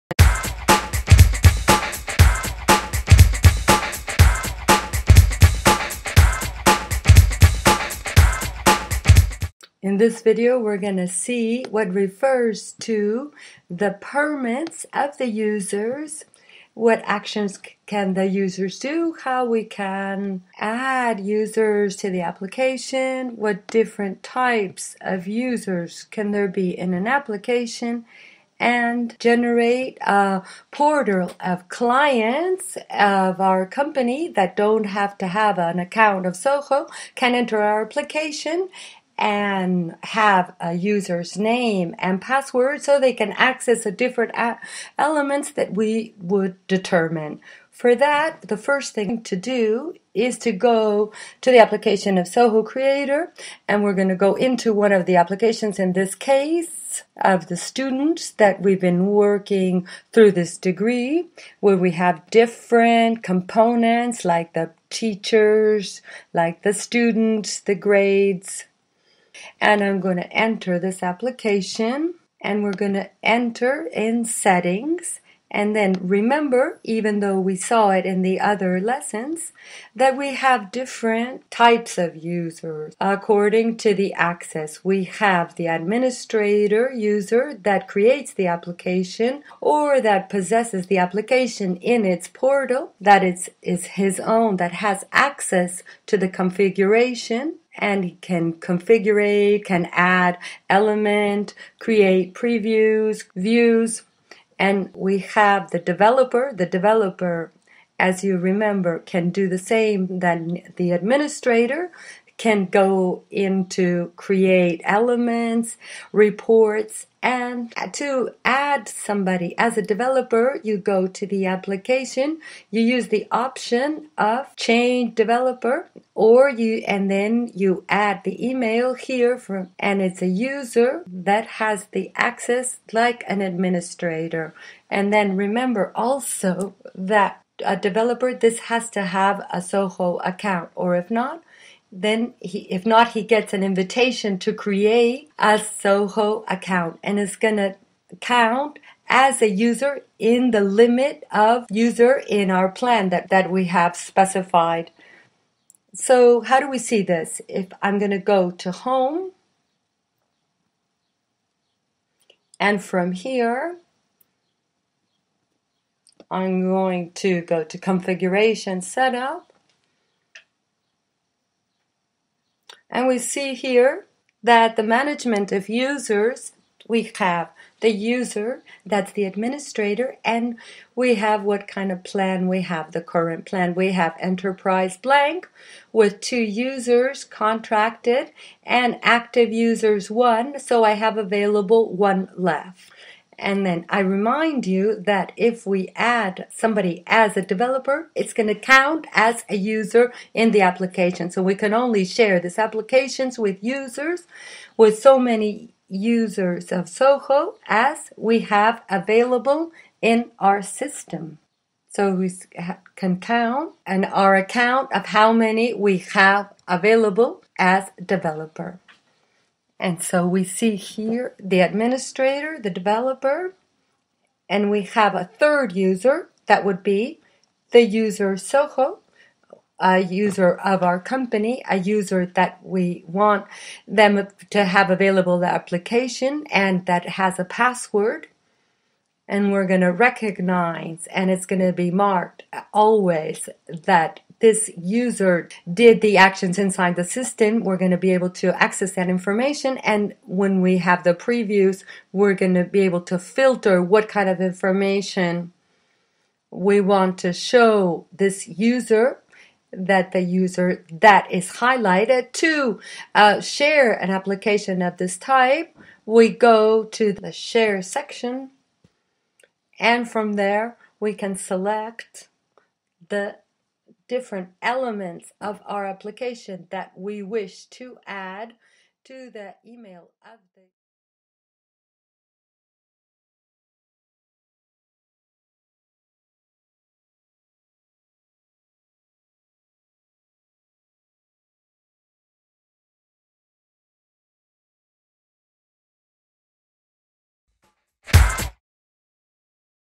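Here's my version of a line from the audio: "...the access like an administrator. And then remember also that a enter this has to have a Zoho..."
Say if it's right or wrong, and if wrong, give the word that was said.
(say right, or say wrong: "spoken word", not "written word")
wrong: "developer", not "enter".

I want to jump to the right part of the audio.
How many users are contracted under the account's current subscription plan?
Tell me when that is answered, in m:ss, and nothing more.
3:06.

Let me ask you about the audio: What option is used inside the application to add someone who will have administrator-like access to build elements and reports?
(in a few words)
change developer.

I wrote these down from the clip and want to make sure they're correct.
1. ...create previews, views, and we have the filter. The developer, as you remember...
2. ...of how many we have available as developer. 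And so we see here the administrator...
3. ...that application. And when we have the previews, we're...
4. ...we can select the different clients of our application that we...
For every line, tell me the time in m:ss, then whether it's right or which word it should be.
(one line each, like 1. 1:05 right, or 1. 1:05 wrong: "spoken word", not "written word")
1. 1:41 wrong: "developer", not "filter"
2. 3:34 right
3. 4:08 wrong: "information", not "application"
4. 4:30 wrong: "elements", not "clients".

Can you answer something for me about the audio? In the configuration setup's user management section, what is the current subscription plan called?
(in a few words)
enterprise blank.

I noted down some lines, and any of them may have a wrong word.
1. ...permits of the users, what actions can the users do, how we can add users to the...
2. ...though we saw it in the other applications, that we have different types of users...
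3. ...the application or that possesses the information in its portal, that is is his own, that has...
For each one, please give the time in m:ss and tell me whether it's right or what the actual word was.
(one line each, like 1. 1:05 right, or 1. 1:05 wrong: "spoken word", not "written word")
1. 0:13 right
2. 1:17 wrong: "lessons", not "applications"
3. 1:28 wrong: "application", not "information".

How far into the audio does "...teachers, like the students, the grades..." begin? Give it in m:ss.
1:04.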